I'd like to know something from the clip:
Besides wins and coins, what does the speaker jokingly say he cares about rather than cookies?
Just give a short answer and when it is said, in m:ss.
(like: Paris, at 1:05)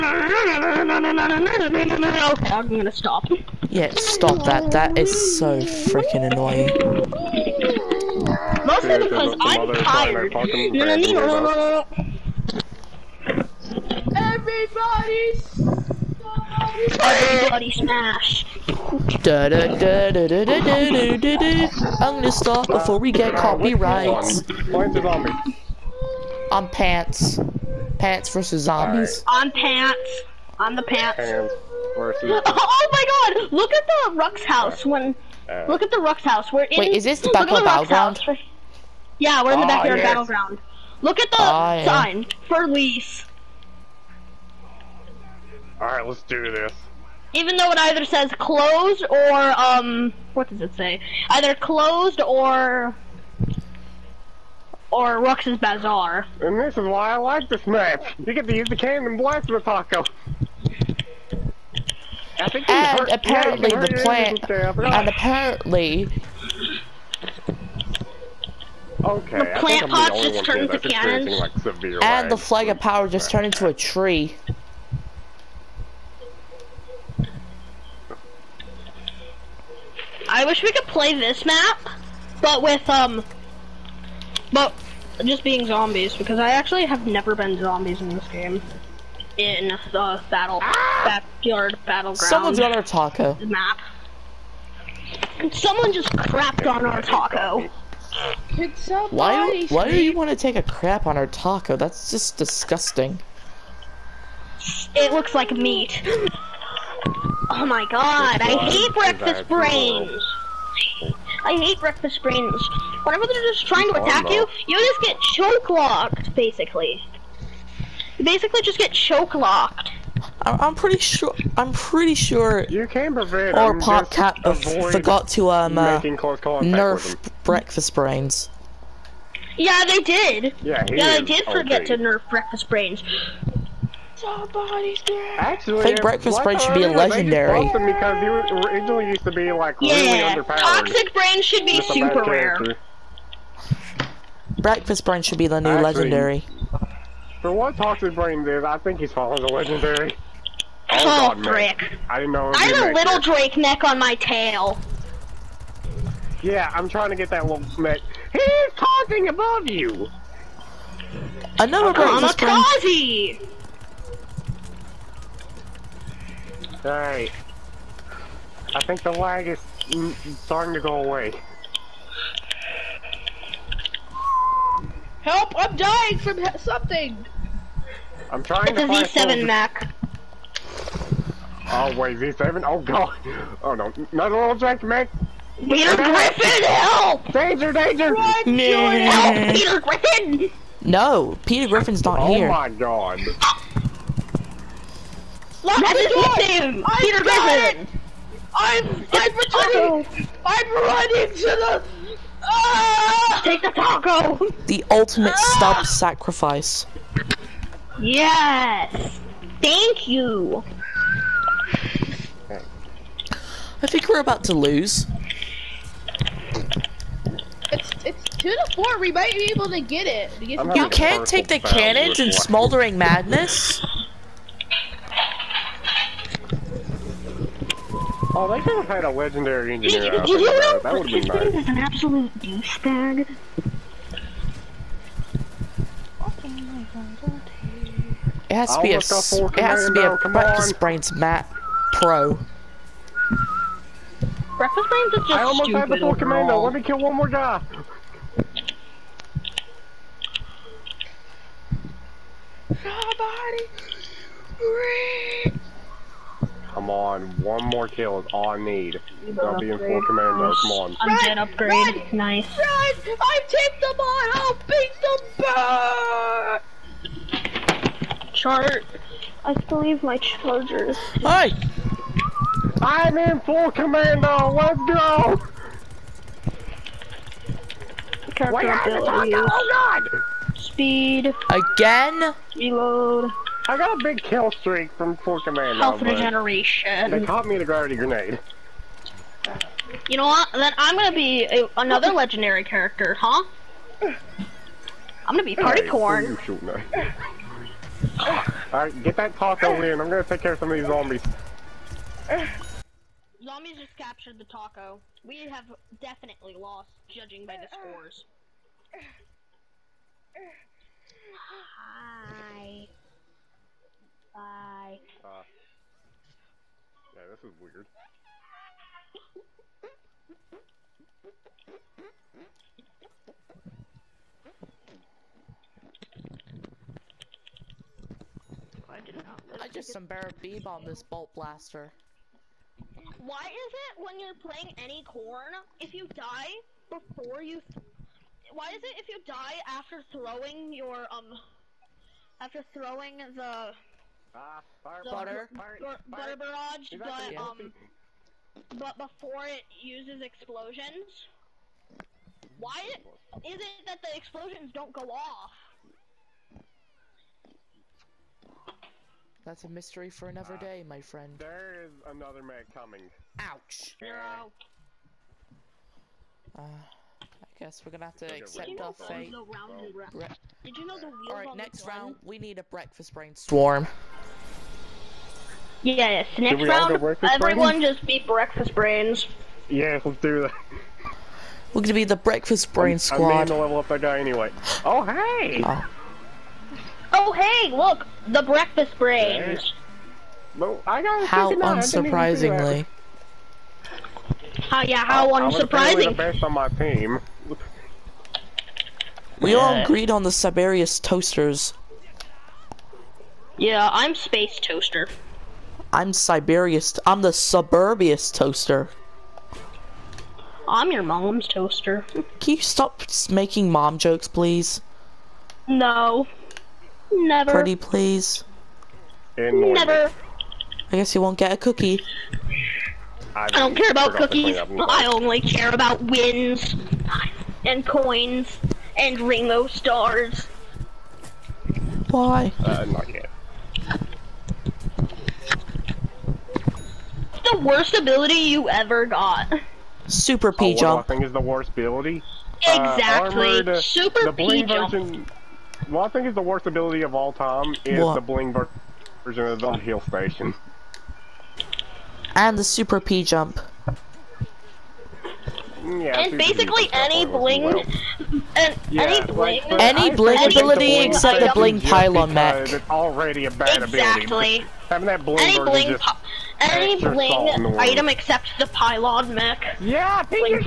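Ringo stars, at 7:09.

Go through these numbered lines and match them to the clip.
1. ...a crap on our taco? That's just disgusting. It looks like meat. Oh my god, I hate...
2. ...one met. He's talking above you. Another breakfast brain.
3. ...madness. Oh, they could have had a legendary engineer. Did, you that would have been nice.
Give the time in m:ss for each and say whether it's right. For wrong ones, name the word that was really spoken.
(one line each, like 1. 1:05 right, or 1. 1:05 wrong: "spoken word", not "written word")
1. 1:40 right
2. 2:37 right
3. 3:42 right.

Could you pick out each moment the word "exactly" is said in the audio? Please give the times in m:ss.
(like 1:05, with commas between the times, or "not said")
7:22, 7:43.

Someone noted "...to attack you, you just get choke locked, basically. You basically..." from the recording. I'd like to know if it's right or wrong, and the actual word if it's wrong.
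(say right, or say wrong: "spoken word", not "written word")
right.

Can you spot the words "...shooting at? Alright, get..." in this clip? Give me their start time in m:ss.
4:56.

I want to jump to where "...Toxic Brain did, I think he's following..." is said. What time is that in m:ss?
2:27.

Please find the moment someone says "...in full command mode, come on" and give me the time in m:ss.
4:19.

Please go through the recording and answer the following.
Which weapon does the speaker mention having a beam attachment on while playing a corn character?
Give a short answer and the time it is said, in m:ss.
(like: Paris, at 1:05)
bolt blaster, at 5:31.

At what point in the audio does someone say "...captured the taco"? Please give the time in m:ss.
5:03.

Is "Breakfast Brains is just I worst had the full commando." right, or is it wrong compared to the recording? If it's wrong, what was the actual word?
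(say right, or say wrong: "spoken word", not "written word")
wrong: "almost", not "worst".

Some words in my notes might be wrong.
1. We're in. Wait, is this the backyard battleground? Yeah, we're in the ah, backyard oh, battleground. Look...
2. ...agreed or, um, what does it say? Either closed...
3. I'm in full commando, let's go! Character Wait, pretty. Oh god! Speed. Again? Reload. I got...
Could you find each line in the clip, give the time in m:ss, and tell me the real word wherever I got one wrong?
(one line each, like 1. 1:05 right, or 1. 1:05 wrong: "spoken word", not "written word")
1. 0:36 right
2. 0:48 wrong: "closed", not "agreed"
3. 4:32 wrong: "ability", not "pretty".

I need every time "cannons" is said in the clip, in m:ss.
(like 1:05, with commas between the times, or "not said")
0:58, 1:10, 3:41.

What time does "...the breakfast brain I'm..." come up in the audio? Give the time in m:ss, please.
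6:22.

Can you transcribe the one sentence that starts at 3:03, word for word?
Oh no, another little drink, Mac.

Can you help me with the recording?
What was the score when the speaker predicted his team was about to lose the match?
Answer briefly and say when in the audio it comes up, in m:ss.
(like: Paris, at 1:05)
2 to 4, at 3:38.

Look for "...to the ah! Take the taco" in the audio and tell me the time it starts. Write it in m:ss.
3:21.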